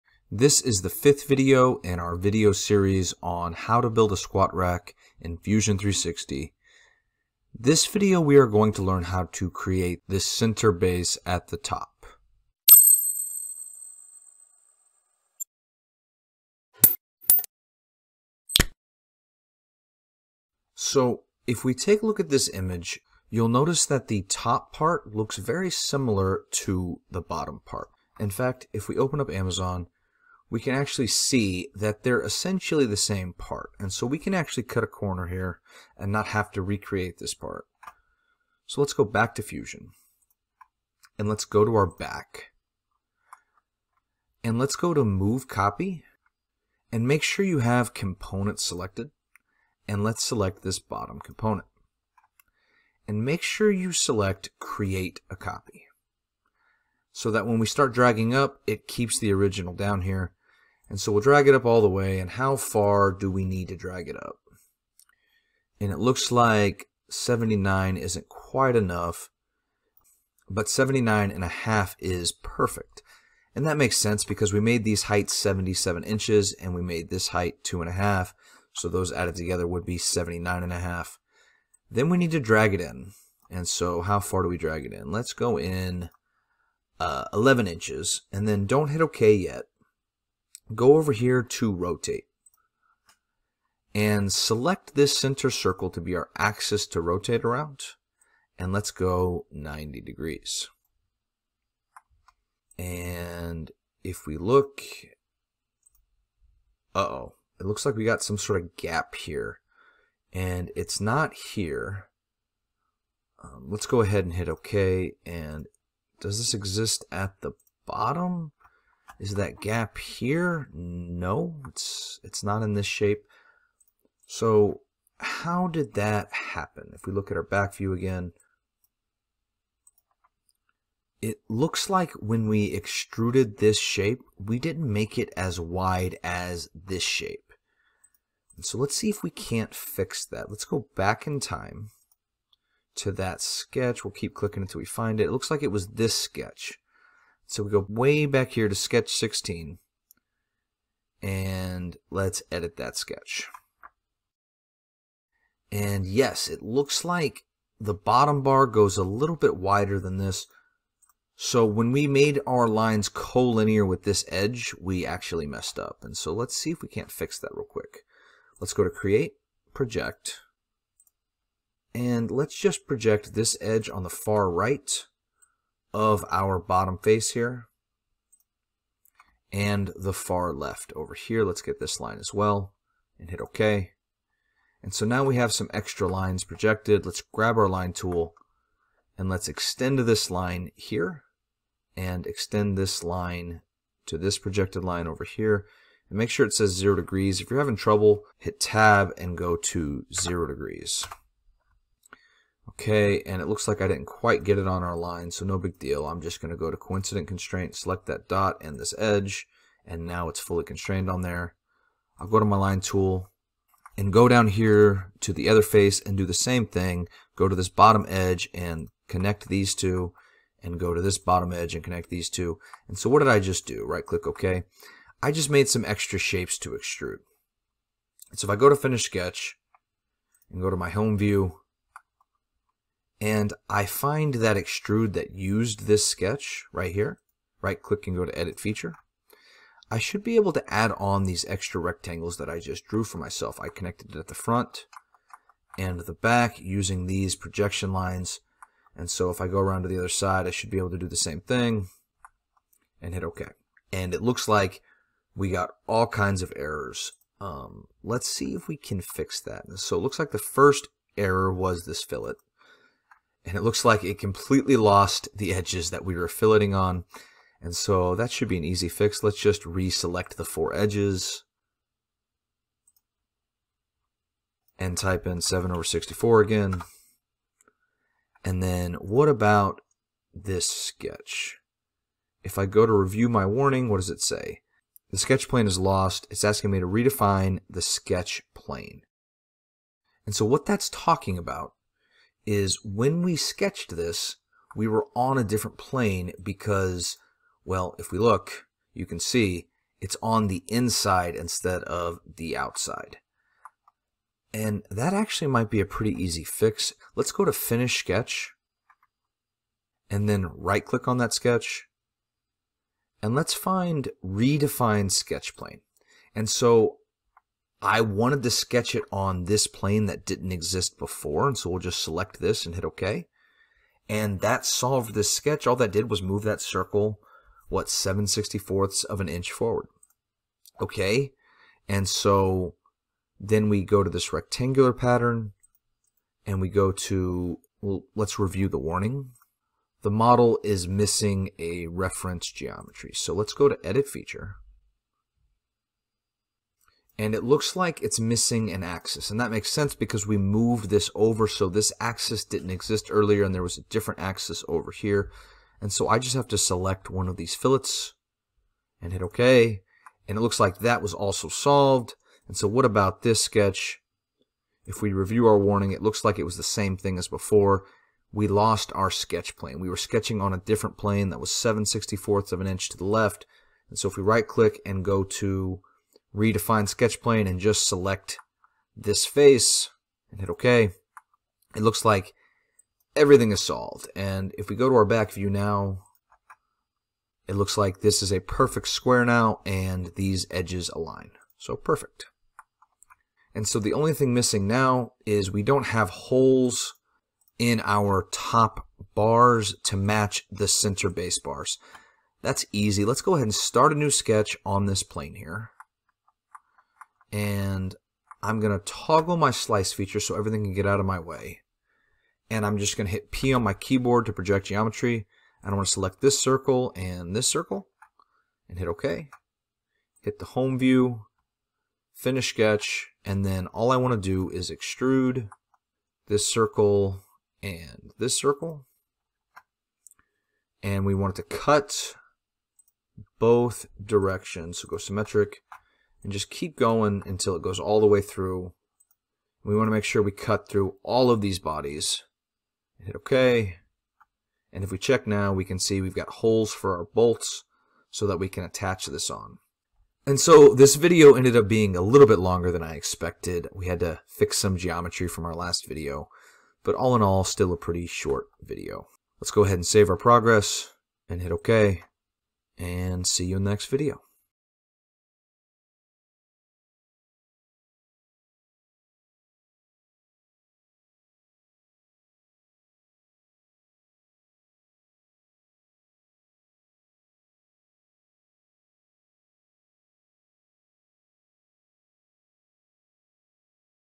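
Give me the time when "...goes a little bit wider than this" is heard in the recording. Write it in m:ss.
2:38.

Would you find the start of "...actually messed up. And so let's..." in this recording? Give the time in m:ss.
2:45.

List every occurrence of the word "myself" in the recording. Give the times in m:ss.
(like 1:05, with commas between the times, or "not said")
4:03.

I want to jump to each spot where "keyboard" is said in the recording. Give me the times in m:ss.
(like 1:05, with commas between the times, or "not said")
6:53.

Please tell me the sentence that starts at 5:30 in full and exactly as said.
Okay, and so then we go to this rectangular pattern, and we go to, well, let's review the warning.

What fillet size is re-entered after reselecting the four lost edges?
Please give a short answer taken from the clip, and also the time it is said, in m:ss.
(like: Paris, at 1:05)
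7/64, at 4:35.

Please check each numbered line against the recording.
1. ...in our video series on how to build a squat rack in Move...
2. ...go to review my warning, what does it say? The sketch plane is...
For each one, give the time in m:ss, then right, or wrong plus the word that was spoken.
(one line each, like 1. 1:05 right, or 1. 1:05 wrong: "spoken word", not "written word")
1. 0:01 wrong: "Fusion", not "Move"
2. 4:42 right.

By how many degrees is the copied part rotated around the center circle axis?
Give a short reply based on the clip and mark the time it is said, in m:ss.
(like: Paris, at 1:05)
90 degrees, at 1:39.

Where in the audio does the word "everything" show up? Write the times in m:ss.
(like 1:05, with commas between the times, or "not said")
6:23, 6:50.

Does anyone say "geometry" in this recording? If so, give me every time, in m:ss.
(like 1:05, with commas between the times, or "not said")
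5:42, 6:54, 7:34.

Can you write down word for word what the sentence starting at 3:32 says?
I'll go to my line tool and go down here to the other face and do the same thing.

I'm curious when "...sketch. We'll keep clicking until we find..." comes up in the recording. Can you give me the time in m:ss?
2:23.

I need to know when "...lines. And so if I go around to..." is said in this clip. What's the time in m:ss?
4:07.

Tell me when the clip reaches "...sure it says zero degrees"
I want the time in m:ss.
3:16.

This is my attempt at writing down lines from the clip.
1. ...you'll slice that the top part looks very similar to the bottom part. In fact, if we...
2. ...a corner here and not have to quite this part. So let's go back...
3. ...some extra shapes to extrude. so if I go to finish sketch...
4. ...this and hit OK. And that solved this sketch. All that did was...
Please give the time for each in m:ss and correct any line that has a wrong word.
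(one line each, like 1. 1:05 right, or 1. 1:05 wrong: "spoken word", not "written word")
1. 0:23 wrong: "notice", not "slice"
2. 0:34 wrong: "recreate", not "quite"
3. 3:45 right
4. 5:22 right.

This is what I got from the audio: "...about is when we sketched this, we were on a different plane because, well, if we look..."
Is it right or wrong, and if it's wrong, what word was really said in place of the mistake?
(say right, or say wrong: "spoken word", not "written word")
right.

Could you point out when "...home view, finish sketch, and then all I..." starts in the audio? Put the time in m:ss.
7:00.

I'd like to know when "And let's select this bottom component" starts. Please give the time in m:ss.
0:49.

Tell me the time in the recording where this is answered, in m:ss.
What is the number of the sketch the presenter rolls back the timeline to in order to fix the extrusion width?
2:28.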